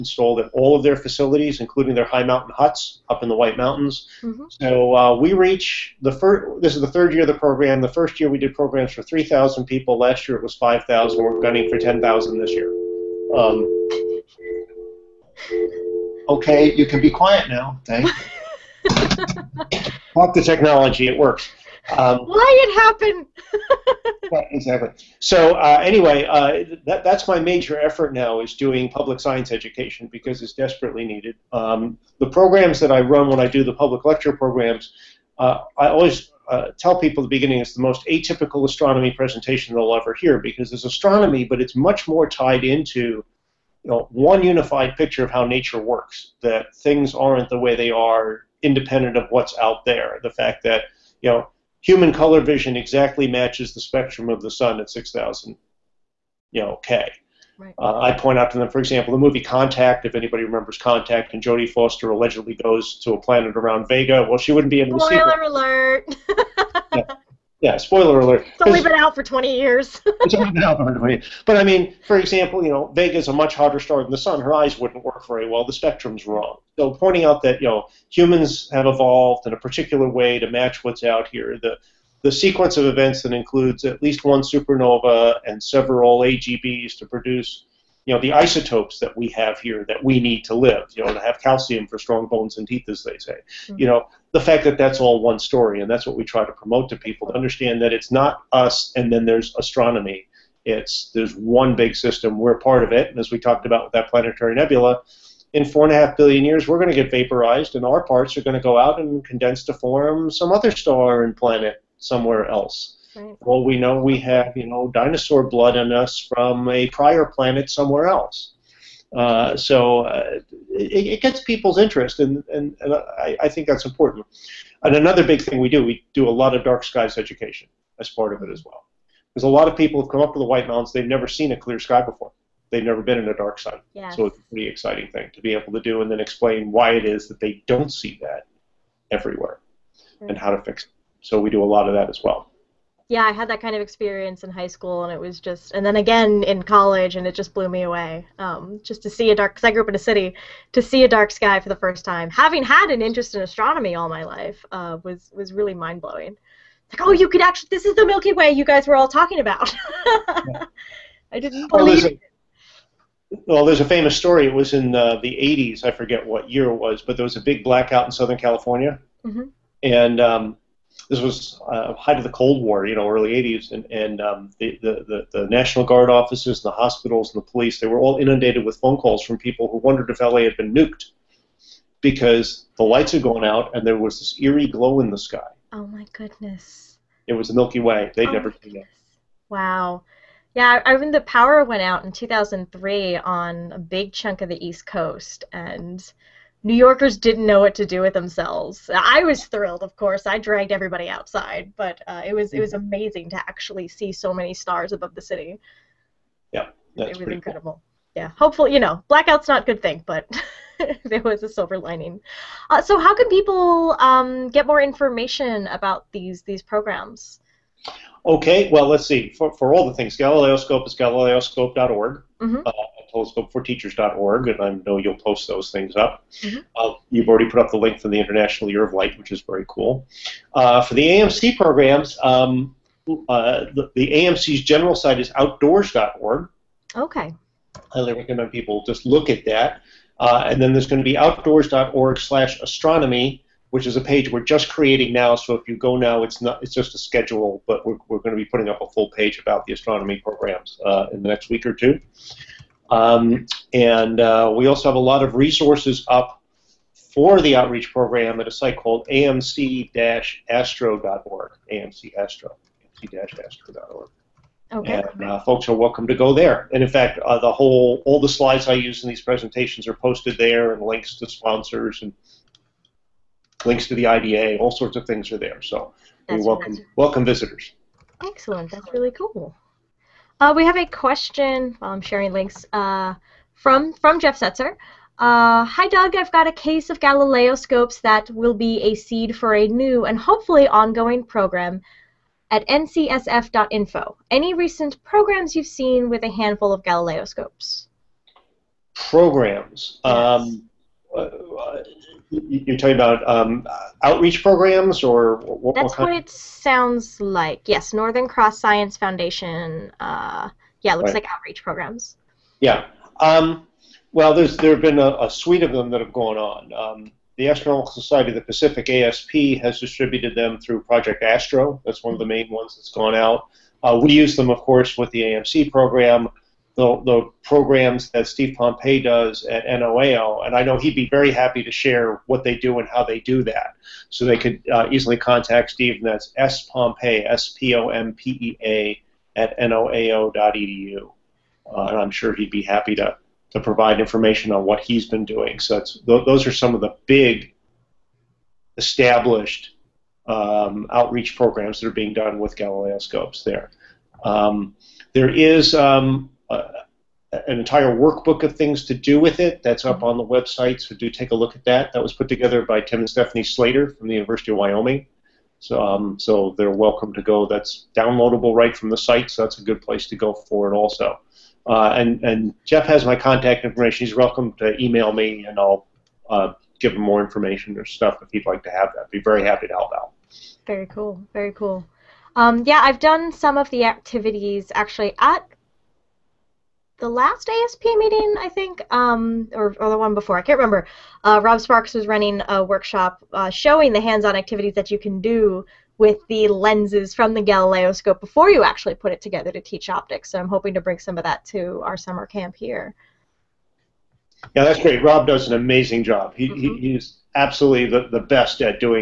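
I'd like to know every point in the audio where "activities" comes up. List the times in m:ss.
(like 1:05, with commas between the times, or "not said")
6:23, 6:34.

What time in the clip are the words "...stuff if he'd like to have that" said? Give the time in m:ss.
6:17.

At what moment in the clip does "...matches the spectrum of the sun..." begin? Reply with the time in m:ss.
0:53.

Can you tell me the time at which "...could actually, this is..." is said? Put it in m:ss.
2:37.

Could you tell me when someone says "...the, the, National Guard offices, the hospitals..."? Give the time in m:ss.
2:54.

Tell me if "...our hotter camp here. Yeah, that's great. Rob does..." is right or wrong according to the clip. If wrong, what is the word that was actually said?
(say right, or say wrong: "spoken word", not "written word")
wrong: "summer", not "hotter".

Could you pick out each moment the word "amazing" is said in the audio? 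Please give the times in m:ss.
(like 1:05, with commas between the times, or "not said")
3:22, 6:45.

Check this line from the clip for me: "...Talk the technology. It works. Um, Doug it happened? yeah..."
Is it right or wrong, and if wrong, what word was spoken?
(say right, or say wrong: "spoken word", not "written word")
wrong: "Why", not "Doug".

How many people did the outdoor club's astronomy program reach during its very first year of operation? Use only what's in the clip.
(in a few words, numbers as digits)
3,000.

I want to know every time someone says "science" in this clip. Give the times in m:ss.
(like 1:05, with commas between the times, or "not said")
0:29, 5:08.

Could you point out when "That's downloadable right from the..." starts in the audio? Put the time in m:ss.
6:07.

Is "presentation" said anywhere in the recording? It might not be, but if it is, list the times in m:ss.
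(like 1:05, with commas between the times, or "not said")
0:39, 4:29.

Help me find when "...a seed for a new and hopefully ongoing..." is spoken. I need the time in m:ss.
4:48.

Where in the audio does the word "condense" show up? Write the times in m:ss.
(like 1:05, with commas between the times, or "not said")
1:49.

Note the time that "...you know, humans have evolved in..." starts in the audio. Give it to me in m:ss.
1:17.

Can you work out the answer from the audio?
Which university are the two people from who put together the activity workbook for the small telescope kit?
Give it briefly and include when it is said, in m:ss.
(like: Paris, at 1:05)
University of Wyoming, at 6:04.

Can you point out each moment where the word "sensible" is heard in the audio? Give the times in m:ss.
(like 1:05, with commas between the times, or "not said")
not said.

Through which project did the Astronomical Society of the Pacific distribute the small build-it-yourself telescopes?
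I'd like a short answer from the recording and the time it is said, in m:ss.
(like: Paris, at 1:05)
Project Astro, at 5:20.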